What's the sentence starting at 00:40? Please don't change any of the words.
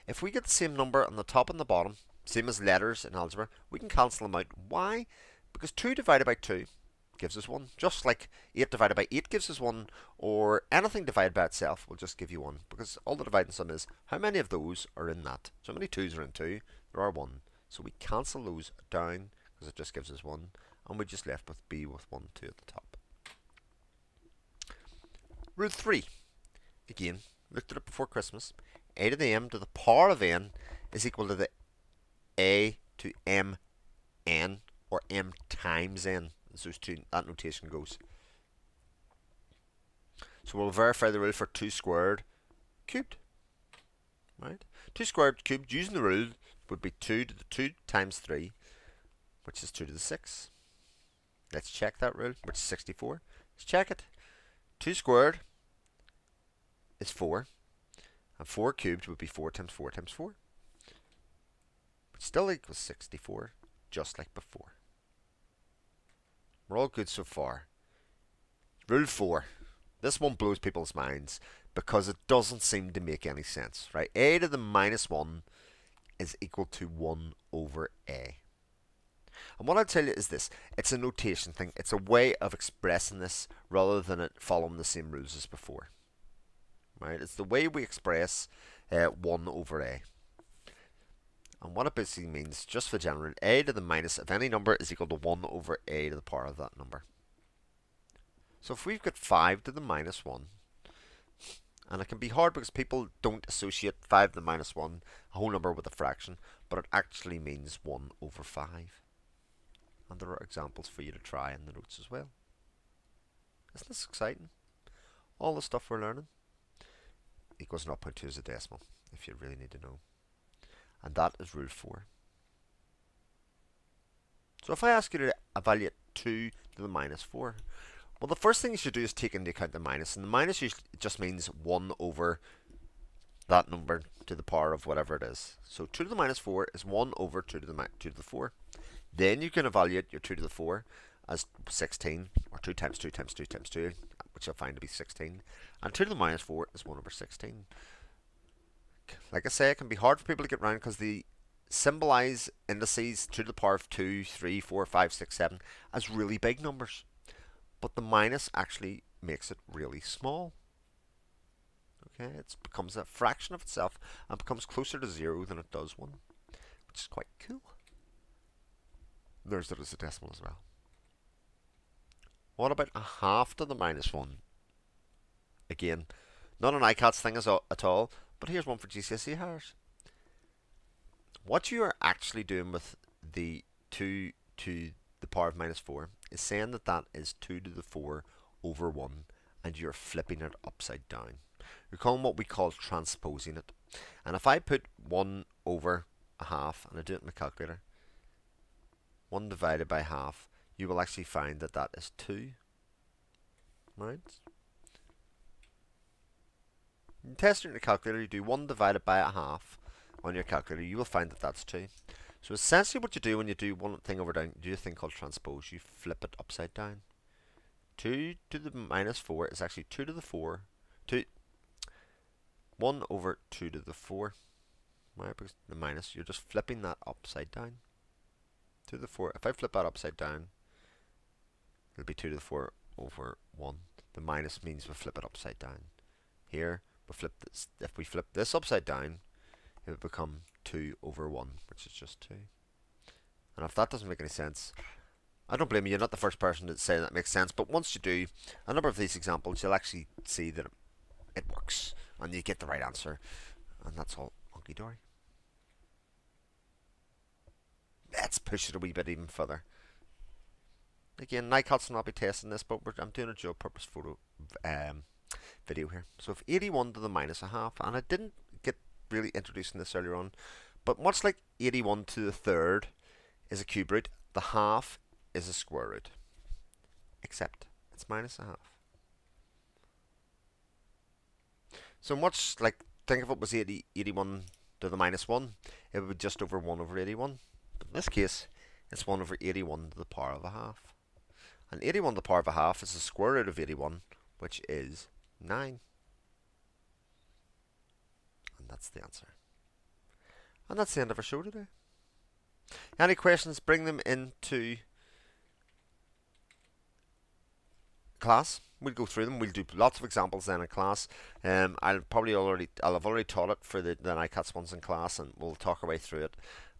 So we'll verify the rule for 2 squared cubed.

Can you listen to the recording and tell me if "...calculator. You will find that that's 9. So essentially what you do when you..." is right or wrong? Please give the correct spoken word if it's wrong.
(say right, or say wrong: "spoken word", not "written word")
wrong: "2", not "9".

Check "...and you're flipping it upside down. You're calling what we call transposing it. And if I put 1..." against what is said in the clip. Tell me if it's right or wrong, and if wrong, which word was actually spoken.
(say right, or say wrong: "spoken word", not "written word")
right.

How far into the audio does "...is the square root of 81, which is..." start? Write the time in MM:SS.
04:52.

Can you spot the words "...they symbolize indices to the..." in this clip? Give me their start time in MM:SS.
02:30.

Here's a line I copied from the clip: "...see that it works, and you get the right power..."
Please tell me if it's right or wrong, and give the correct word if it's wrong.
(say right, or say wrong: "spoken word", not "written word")
wrong: "answer", not "power".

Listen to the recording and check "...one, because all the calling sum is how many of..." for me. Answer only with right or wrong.
wrong.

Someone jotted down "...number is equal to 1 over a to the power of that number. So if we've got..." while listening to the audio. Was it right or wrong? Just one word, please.
right.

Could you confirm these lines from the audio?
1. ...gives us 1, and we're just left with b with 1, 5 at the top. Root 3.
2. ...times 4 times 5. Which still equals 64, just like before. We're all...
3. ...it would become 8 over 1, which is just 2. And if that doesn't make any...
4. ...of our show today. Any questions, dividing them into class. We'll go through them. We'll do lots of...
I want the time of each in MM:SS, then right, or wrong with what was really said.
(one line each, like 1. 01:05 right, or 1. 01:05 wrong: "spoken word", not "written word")
1. 00:19 wrong: "2", not "5"
2. 00:59 wrong: "4", not "5"
3. 03:59 wrong: "2", not "8"
4. 05:01 wrong: "bring", not "dividing".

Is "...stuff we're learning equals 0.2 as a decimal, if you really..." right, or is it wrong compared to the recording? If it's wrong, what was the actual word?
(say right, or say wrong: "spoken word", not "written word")
right.